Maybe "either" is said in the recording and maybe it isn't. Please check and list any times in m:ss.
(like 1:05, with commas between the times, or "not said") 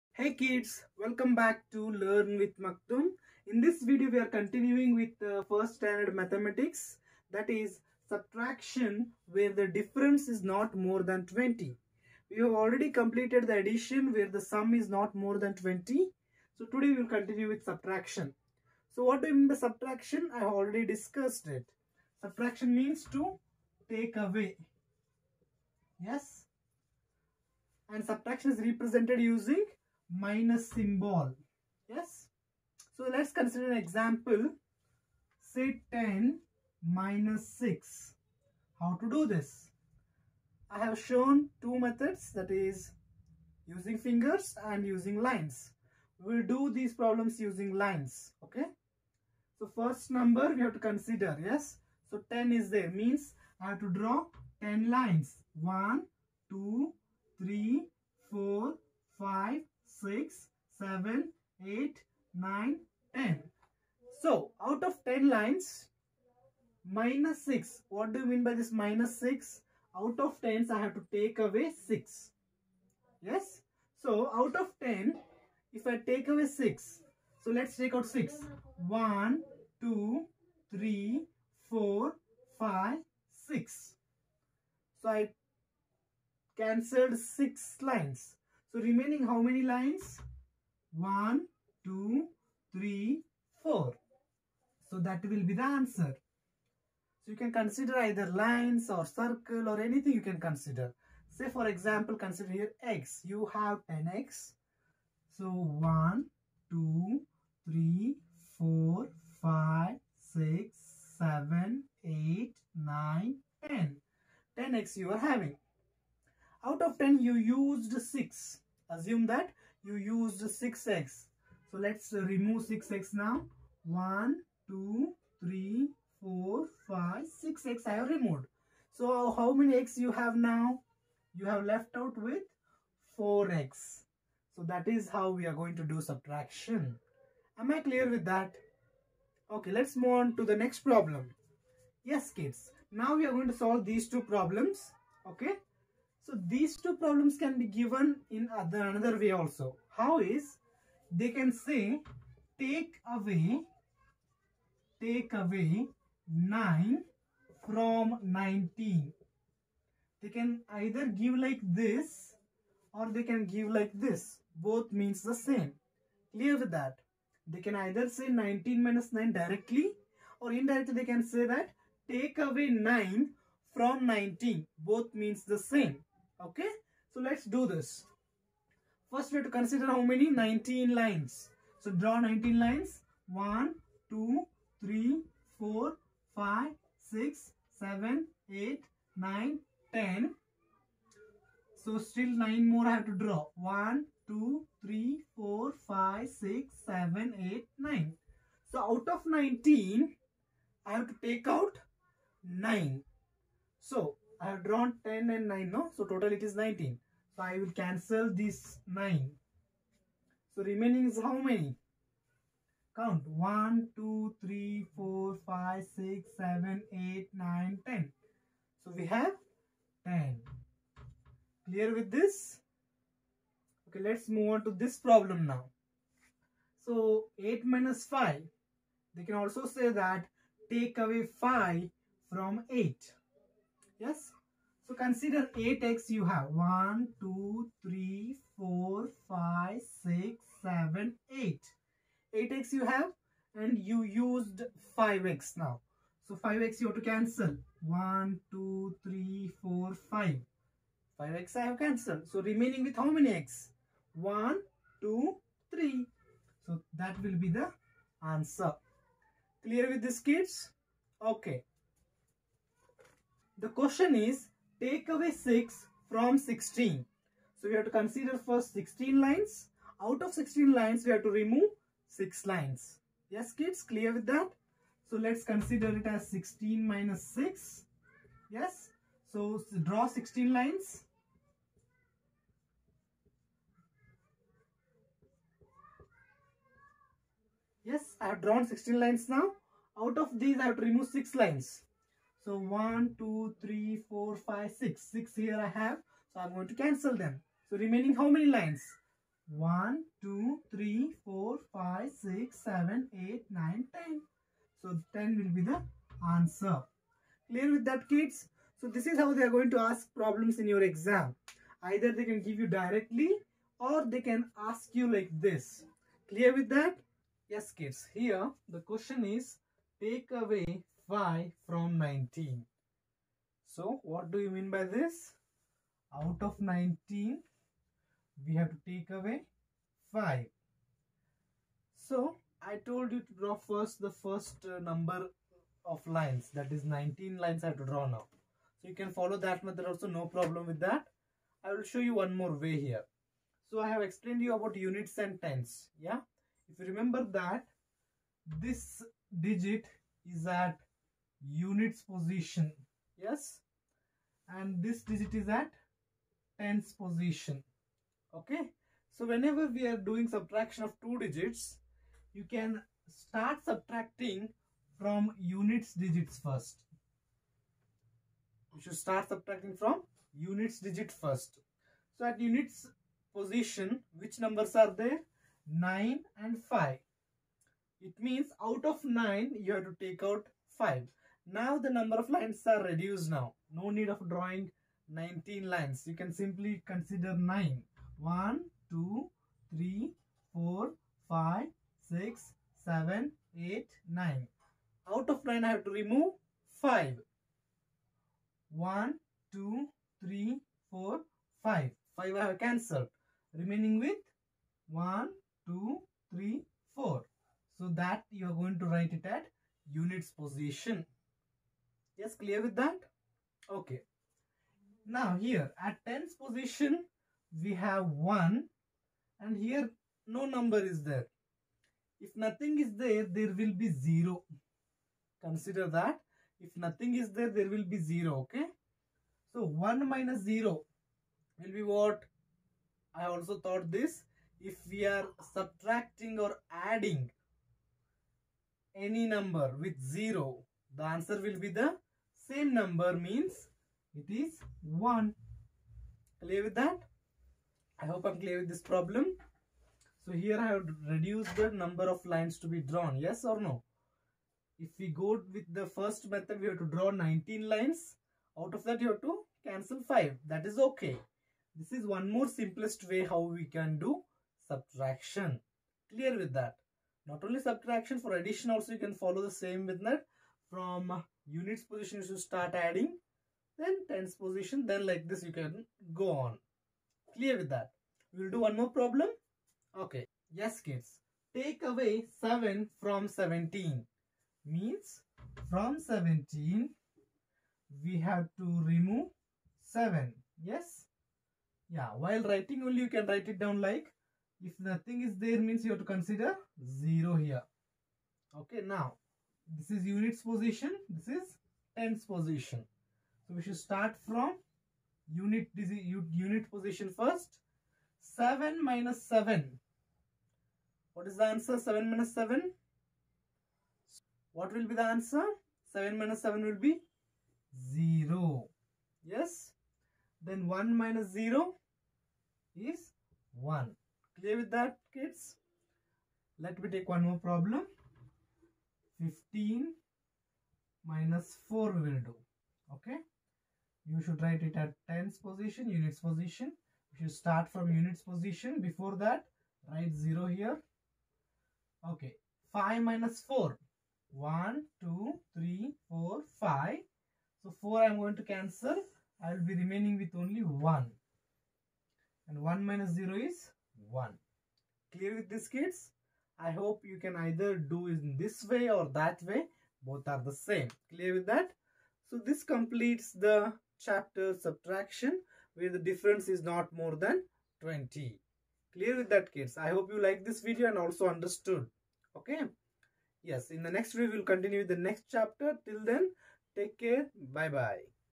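1:37, 2:40, 2:47, 5:11, 9:17.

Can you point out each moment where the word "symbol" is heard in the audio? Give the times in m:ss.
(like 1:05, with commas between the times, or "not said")
0:30.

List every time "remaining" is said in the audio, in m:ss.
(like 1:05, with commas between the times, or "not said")
1:28, 3:30, 4:12, 4:57, 6:43, 9:09.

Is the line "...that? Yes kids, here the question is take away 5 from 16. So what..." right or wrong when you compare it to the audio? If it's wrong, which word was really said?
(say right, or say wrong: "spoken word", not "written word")
wrong: "19", not "16".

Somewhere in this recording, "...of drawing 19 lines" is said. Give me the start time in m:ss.
6:24.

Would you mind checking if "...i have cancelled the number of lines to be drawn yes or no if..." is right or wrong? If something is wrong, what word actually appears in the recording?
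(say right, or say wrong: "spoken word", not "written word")
wrong: "reduced", not "cancelled".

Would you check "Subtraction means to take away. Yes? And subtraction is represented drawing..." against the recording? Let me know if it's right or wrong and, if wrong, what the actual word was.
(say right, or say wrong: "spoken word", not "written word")
wrong: "using", not "drawing".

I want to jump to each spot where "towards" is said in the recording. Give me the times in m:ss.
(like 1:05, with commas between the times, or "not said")
not said.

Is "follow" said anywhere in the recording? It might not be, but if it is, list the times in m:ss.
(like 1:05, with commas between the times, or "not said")
5:39, 7:49.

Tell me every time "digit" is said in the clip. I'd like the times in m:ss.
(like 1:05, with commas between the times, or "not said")
5:49, 5:55, 6:01, 6:05, 6:10.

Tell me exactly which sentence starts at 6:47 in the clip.
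So that you are going to write it at units position.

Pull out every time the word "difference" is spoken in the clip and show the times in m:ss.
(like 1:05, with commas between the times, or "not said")
0:09, 9:25.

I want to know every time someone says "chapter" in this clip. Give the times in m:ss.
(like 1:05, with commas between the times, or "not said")
9:23, 9:35.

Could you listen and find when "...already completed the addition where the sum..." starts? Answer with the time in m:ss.
0:12.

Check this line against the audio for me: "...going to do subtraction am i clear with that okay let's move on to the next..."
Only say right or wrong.
right.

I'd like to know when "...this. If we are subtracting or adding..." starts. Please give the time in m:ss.
7:13.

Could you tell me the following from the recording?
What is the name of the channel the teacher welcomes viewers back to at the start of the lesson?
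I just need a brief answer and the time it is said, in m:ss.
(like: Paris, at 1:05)
Learn with Maktum, at 0:01.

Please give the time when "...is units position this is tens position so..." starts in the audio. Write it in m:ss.
8:19.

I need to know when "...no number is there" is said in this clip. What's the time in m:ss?
7:00.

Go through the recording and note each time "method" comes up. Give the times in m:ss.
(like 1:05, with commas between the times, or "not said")
0:41, 5:39, 7:36, 7:49.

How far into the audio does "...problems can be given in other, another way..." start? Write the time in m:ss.
2:26.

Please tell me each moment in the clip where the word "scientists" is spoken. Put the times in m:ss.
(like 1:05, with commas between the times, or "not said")
not said.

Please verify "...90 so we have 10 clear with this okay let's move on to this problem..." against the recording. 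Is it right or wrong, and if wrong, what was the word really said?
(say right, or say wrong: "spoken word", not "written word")
wrong: "10", not "90".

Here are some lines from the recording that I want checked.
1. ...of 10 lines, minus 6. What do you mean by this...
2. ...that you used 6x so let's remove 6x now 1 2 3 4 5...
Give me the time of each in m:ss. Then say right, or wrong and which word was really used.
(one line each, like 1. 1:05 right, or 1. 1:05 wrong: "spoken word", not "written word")
1. 1:04 right
2. 1:59 right.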